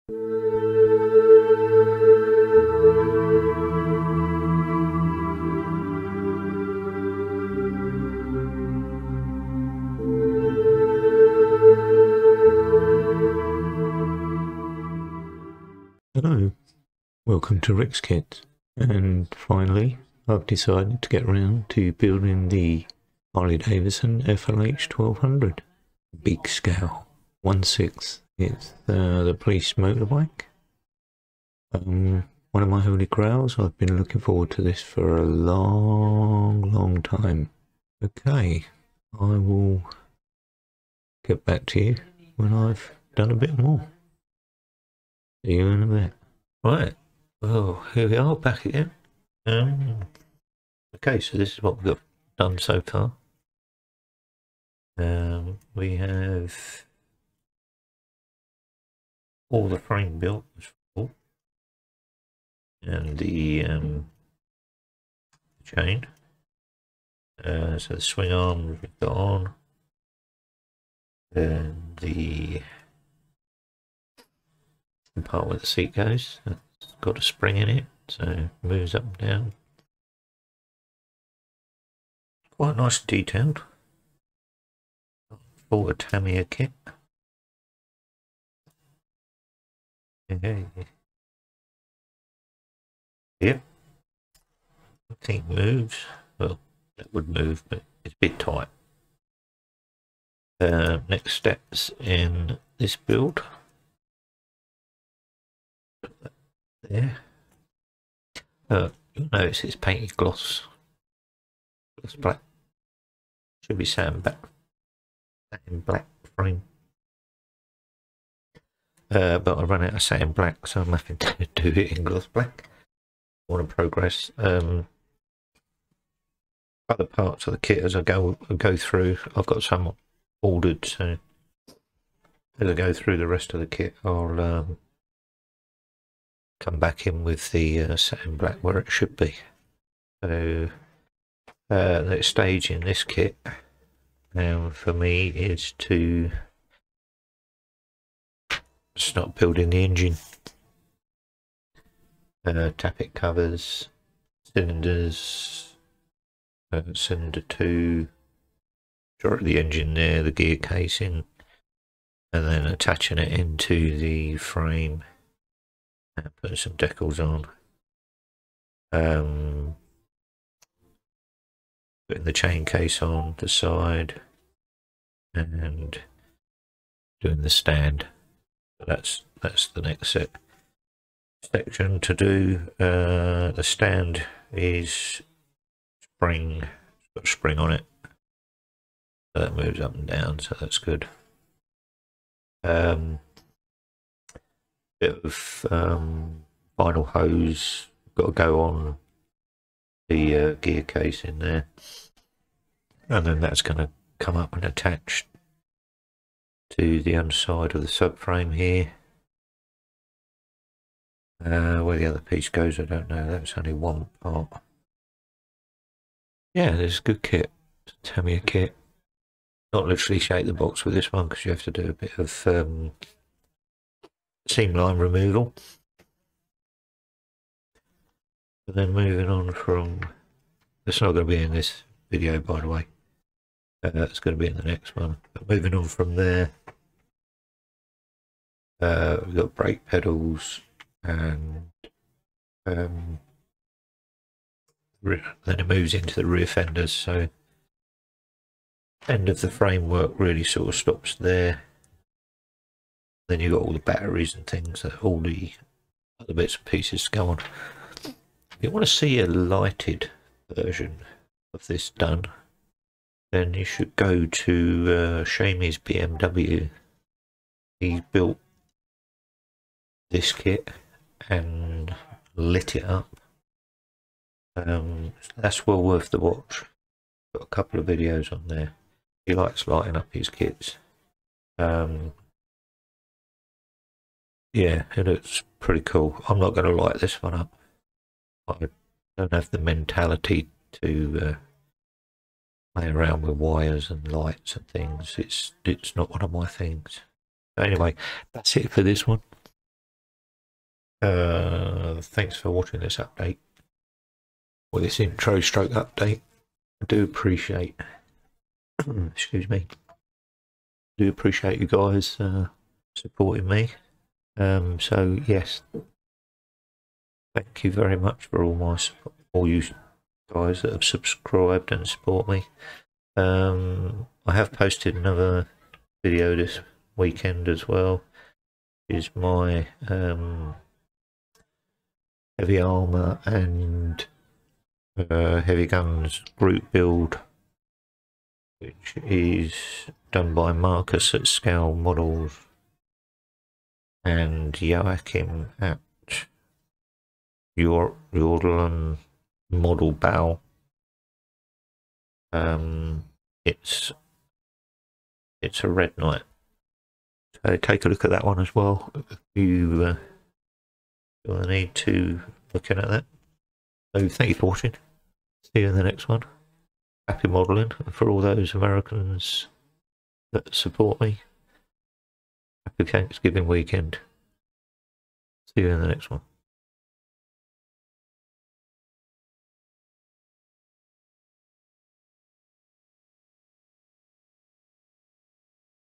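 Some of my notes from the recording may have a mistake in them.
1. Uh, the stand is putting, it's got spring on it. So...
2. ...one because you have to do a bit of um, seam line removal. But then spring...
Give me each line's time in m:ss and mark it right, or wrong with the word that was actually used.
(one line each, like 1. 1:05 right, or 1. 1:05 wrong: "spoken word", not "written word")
1. 3:02 wrong: "spring", not "putting"
2. 3:41 wrong: "moving", not "spring".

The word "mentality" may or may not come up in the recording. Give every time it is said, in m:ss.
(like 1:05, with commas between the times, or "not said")
4:49.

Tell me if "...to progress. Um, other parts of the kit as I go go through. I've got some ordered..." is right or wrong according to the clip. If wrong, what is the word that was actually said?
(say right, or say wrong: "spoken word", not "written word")
right.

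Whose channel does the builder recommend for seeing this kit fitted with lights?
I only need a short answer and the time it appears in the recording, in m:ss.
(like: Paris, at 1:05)
Seamy's BMW, at 4:25.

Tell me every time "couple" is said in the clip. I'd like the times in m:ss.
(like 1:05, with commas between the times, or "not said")
4:37.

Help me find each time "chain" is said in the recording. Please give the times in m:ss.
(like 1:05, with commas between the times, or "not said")
1:05, 2:52.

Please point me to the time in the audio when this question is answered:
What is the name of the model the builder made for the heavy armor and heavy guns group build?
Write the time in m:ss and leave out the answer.
5:55.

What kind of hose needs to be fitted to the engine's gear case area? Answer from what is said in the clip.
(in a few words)
Vinyl.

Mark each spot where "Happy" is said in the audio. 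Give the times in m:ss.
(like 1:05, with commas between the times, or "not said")
6:07, 6:12.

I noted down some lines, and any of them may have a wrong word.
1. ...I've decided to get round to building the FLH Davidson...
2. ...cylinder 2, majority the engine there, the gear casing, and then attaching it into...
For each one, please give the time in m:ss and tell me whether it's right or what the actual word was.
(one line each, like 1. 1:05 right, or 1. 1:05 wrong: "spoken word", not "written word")
1. 0:20 wrong: "Harley", not "FLH"
2. 2:36 right.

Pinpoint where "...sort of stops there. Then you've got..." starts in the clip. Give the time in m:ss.
4:10.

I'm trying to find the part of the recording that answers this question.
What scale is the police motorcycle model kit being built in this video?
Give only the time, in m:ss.
0:27.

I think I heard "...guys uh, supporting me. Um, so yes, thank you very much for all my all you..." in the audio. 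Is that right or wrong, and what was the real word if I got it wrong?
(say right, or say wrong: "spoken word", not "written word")
right.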